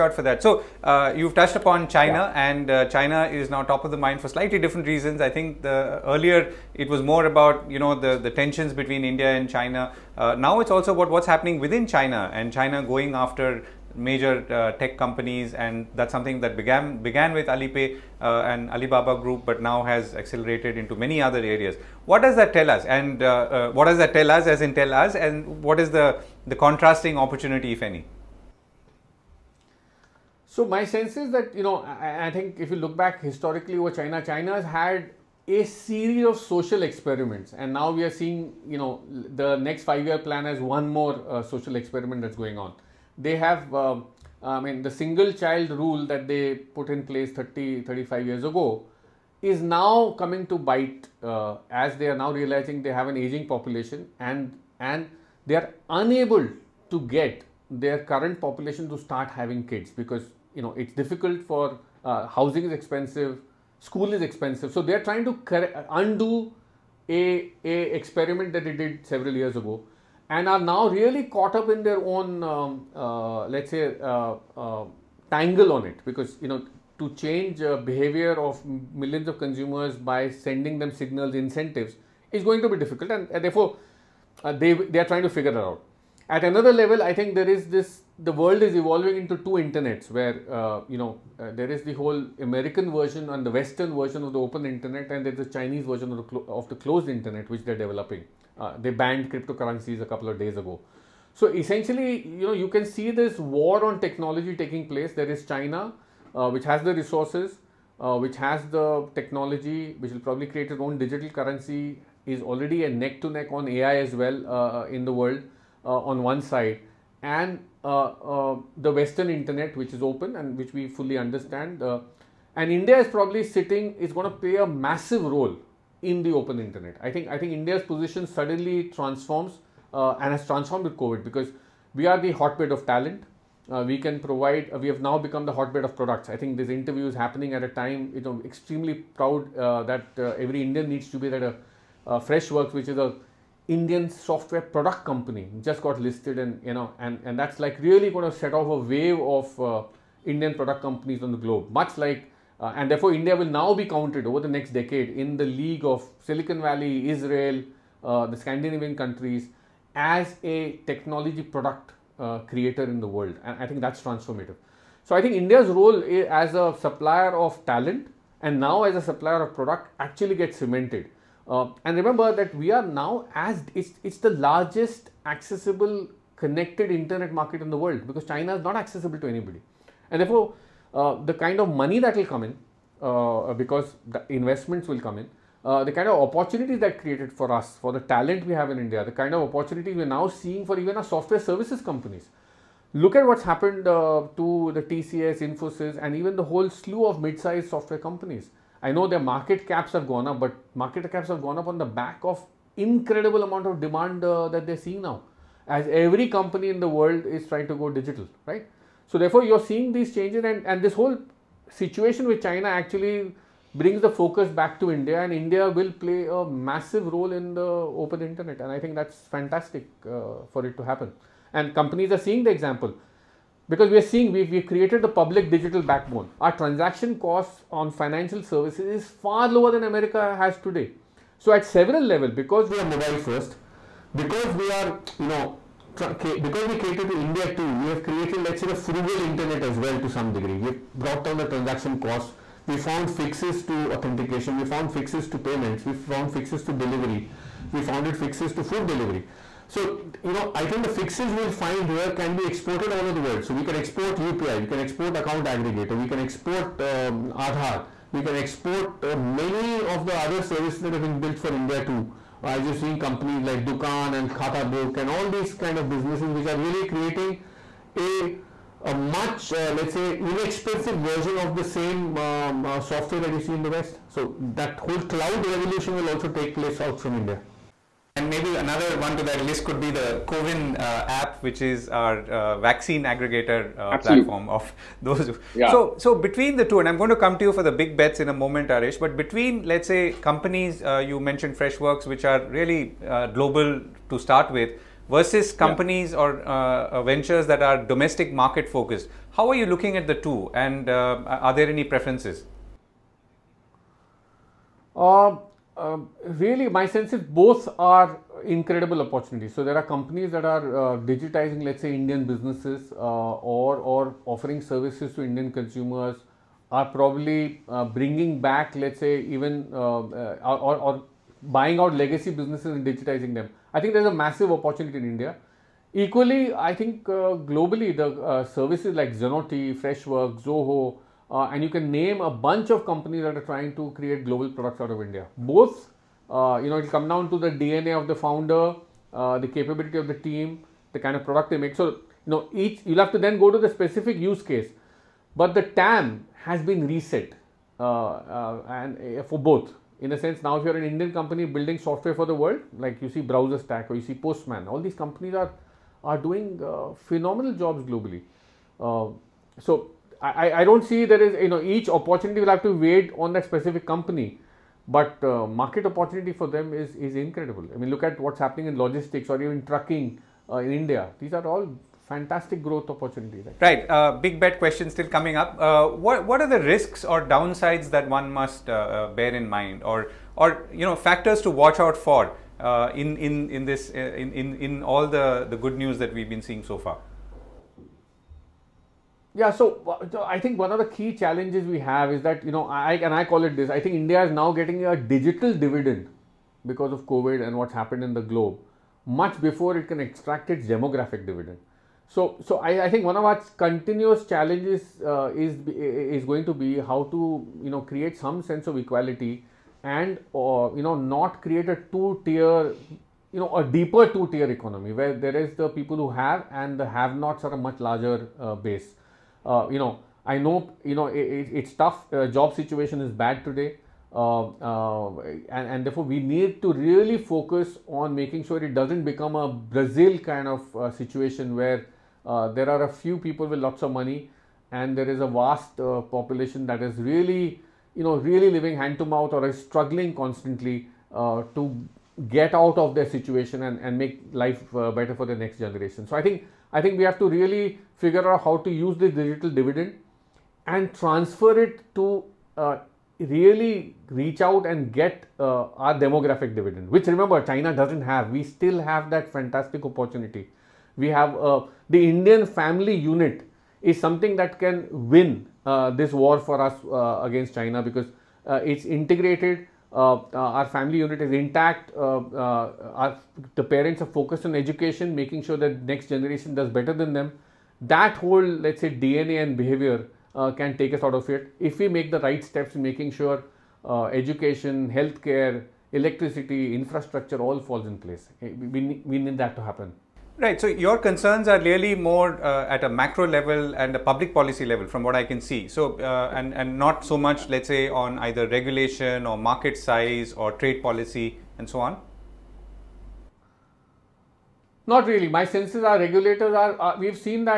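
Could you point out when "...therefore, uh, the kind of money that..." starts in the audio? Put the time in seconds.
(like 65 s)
180 s.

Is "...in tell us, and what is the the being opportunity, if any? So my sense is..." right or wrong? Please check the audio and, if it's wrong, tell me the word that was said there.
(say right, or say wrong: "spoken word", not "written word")
wrong: "contrasting", not "being".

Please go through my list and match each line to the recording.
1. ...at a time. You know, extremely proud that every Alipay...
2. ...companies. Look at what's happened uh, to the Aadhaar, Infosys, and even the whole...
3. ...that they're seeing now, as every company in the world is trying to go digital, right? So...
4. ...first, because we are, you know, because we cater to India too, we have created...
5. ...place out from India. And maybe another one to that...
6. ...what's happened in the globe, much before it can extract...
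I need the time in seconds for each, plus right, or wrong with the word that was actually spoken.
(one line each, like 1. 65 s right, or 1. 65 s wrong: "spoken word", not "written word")
1. 137 s wrong: "Indian", not "Alipay"
2. 191 s wrong: "TCS", not "Aadhaar"
3. 204 s right
4. 233 s right
5. 276 s right
6. 397 s right.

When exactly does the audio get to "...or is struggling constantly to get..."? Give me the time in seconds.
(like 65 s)
439 s.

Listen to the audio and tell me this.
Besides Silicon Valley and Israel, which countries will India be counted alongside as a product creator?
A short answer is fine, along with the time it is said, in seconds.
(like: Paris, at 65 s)
the Scandinavian countries, at 158 s.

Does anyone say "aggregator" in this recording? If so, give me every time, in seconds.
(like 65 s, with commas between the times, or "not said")
255 s, 283 s.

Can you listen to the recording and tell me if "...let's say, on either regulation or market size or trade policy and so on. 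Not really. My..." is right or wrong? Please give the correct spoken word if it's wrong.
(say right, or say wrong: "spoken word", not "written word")
right.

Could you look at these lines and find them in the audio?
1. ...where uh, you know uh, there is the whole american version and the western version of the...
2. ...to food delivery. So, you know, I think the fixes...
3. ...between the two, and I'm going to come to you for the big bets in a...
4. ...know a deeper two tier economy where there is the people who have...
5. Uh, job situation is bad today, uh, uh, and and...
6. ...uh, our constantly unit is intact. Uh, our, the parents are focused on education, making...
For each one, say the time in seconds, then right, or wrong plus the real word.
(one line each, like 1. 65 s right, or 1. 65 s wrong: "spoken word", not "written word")
1. 90 s right
2. 248 s right
3. 286 s right
4. 413 s right
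5. 422 s right
6. 470 s wrong: "family", not "constantly".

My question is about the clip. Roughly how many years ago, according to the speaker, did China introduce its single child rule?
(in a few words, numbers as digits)
30 35.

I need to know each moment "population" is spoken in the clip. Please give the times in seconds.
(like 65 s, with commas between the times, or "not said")
53 s, 58 s, 436 s.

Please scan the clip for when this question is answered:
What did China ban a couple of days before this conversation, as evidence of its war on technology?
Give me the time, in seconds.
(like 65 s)
99 s.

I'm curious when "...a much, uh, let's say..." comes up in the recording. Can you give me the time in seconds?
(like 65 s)
268 s.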